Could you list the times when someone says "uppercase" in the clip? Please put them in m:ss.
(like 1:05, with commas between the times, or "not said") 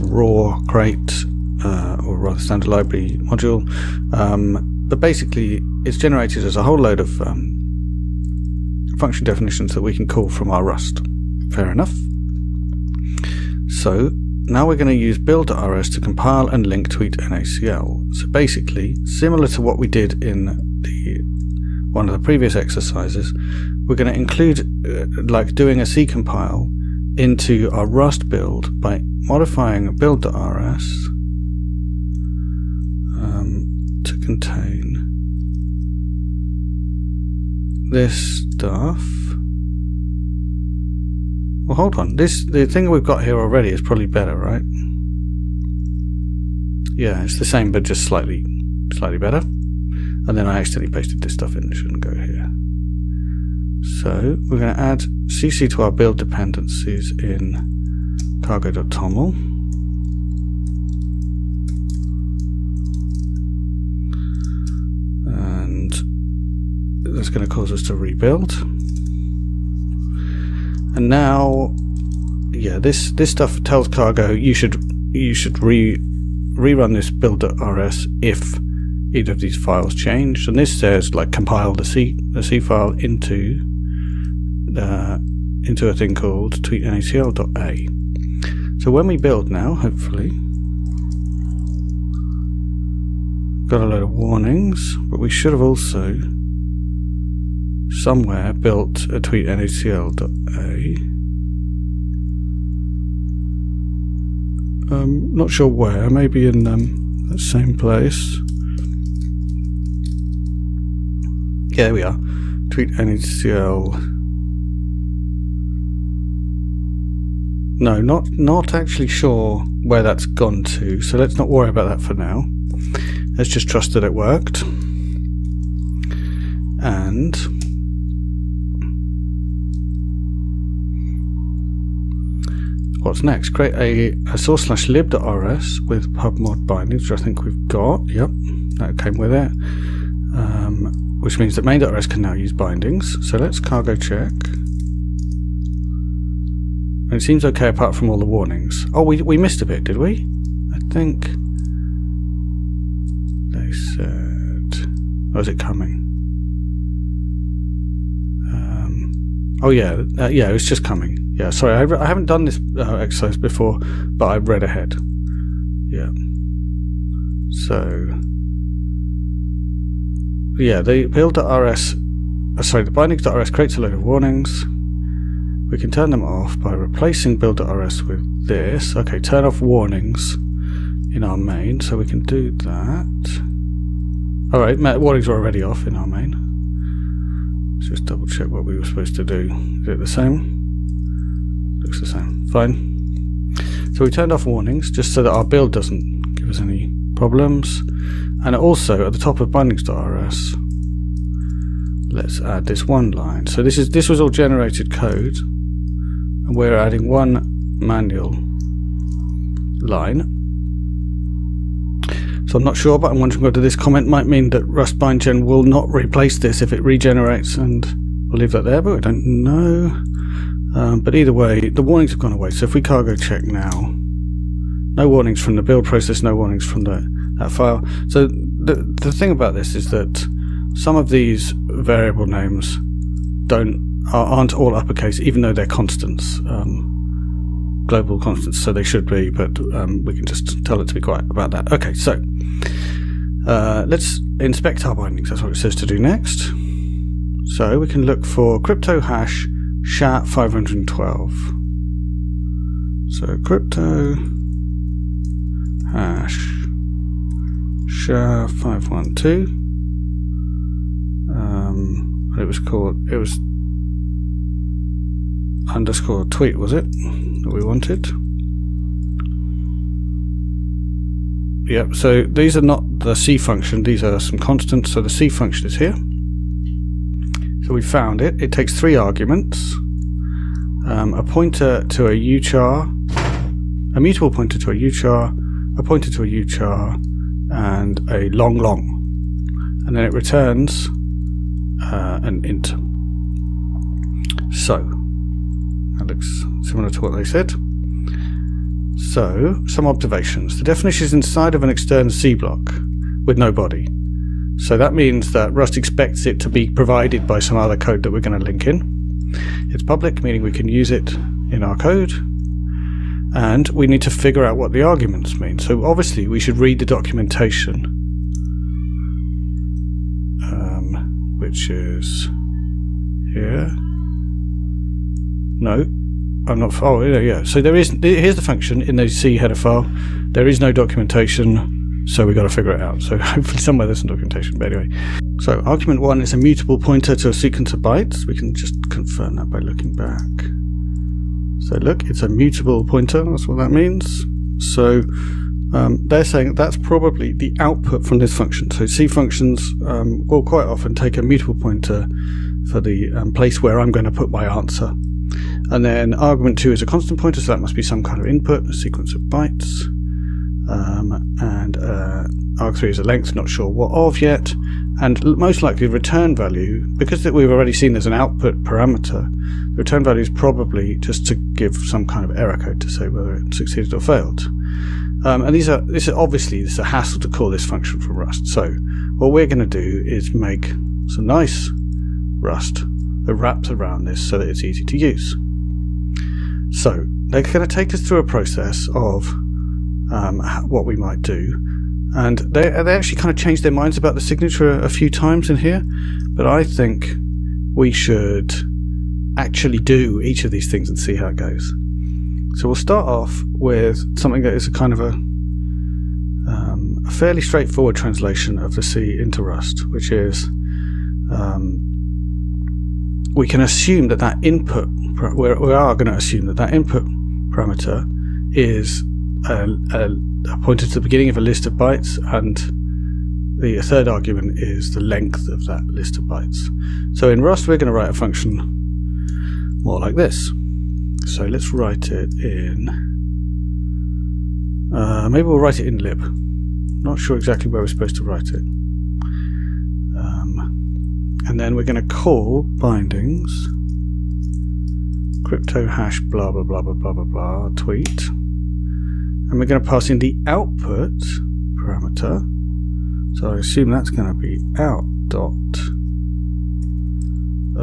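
3:54.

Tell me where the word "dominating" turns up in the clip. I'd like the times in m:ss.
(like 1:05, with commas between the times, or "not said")
not said.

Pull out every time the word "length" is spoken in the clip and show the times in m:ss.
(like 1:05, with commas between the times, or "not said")
6:03, 7:05.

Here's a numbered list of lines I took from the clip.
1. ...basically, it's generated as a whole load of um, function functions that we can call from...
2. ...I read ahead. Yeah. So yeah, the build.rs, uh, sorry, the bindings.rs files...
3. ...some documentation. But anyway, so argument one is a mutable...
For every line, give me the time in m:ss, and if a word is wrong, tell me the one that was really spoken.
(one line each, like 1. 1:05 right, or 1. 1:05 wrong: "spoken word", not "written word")
1. 0:05 wrong: "definitions", not "functions"
2. 2:44 wrong: "creates", not "files"
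3. 5:33 right.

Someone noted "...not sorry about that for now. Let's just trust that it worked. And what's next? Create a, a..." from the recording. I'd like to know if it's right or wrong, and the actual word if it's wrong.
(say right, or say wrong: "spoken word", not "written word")
wrong: "worry", not "sorry".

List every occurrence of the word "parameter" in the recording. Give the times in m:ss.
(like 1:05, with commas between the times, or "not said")
6:08, 6:57, 7:31.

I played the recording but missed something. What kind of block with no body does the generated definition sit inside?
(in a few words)
external C block.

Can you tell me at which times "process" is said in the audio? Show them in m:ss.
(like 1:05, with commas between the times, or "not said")
3:45, 6:28.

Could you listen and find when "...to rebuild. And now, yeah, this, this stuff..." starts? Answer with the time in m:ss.
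1:07.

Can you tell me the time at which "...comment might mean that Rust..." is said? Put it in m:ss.
3:33.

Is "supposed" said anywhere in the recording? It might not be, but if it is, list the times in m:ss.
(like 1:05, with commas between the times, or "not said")
3:08, 7:17.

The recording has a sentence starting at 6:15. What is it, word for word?
Um, and these are this is obviously this is a hassle to call this function from Rust.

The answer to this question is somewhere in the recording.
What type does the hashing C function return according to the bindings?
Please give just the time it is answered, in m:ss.
4:52.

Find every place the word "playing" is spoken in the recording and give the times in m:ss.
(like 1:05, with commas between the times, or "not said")
not said.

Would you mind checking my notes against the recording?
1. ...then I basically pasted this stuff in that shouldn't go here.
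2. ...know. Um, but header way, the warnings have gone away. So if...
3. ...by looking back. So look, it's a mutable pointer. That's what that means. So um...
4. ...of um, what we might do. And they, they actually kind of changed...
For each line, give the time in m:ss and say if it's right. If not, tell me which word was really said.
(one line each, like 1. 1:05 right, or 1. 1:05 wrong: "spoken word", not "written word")
1. 0:50 wrong: "accidentally", not "basically"
2. 3:39 wrong: "either", not "header"
3. 5:39 right
4. 6:28 right.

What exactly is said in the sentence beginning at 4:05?
That's what it says to do next.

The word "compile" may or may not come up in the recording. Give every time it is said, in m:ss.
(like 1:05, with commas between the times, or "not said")
0:16, 0:26, 1:21.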